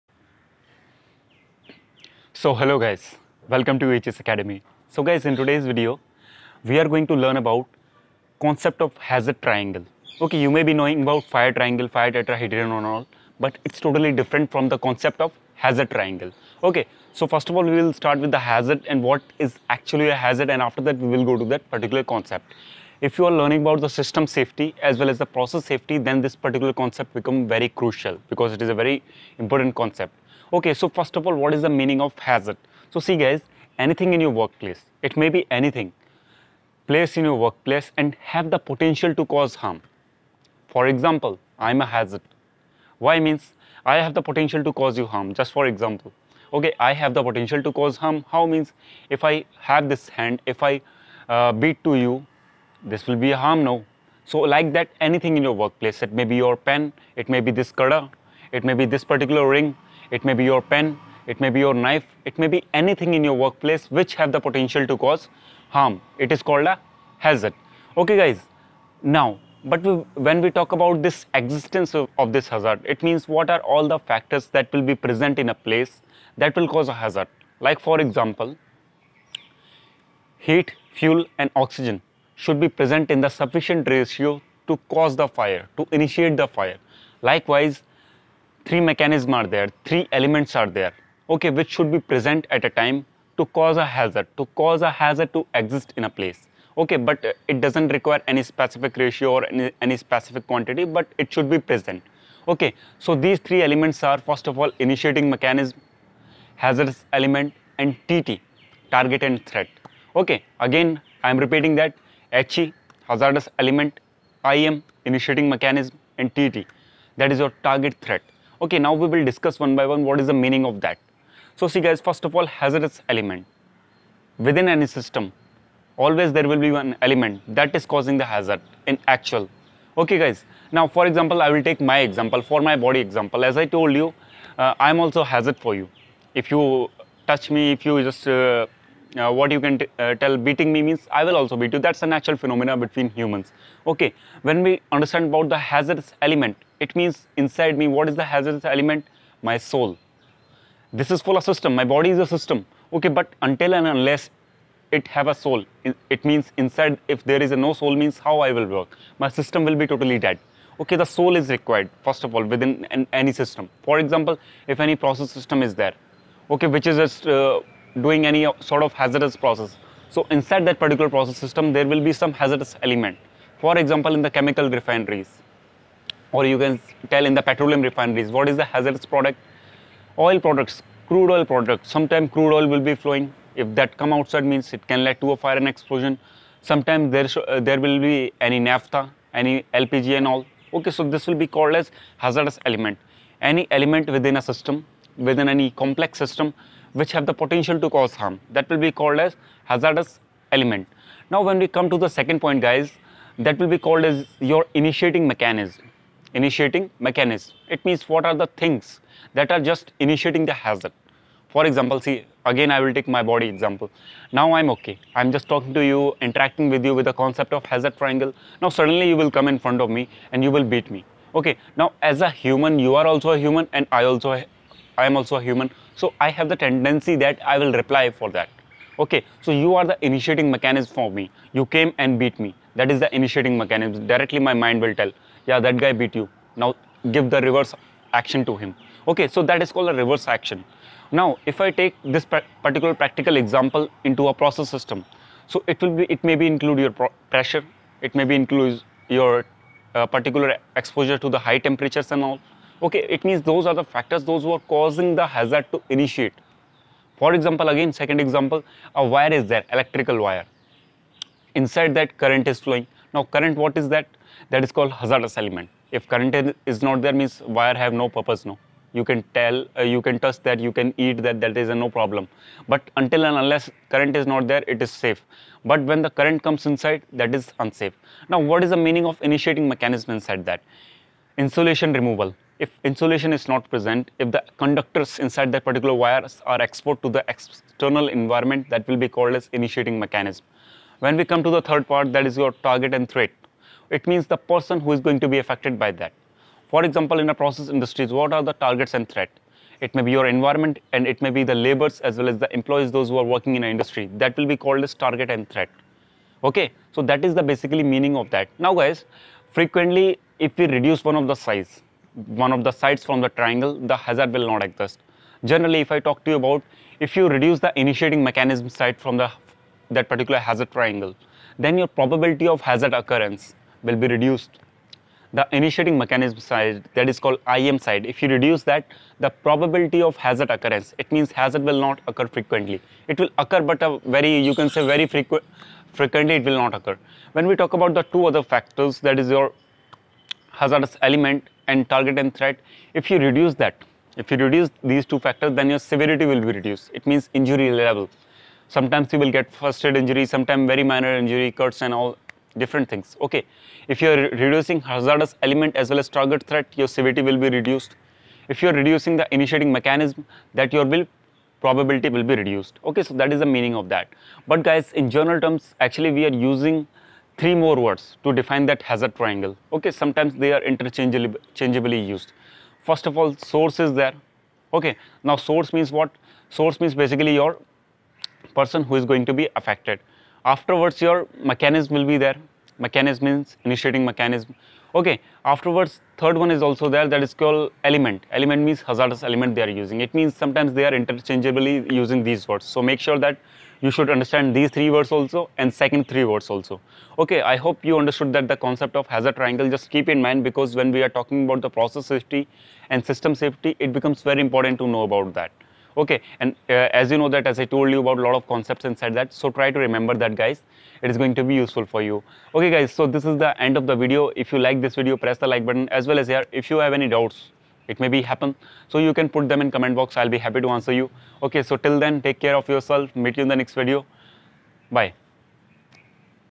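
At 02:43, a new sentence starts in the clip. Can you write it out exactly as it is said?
For example, if any process system is there, okay, which is just uh, doing any sort of hazardous process.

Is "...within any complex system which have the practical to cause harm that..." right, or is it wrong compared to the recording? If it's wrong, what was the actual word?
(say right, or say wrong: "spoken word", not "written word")
wrong: "potential", not "practical".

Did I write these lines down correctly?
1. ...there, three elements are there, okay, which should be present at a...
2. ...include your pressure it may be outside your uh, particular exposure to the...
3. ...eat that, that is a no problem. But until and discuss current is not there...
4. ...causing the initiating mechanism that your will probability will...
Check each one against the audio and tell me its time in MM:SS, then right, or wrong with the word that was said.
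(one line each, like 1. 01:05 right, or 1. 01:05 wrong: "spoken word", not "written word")
1. 01:29 right
2. 04:06 wrong: "include", not "outside"
3. 04:30 wrong: "unless", not "discuss"
4. 05:58 wrong: "reducing", not "causing".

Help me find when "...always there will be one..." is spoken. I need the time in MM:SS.
02:05.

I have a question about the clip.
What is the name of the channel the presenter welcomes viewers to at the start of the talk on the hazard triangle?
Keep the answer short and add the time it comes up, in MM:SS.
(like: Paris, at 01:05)
HS Academy, at 00:03.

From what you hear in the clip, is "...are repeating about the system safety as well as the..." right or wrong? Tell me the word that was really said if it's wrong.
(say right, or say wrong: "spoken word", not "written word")
wrong: "learning", not "repeating".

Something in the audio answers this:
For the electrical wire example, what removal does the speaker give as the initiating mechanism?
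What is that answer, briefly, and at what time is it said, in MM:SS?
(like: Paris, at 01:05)
Insulation removal, at 04:41.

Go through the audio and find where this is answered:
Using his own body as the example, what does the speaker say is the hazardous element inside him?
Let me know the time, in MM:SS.
02:29.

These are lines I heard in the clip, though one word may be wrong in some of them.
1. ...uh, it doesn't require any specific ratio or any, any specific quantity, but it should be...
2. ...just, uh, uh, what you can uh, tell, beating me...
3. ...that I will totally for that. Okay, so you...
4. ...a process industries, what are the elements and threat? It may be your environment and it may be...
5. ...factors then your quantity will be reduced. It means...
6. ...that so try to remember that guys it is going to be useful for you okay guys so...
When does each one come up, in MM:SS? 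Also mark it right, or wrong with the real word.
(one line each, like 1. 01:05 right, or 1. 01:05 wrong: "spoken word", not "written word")
1. 01:37 right
2. 02:18 right
3. 03:47 wrong: "reply", not "totally"
4. 04:57 wrong: "targets", not "elements"
5. 05:45 wrong: "severity", not "quantity"
6. 06:49 right.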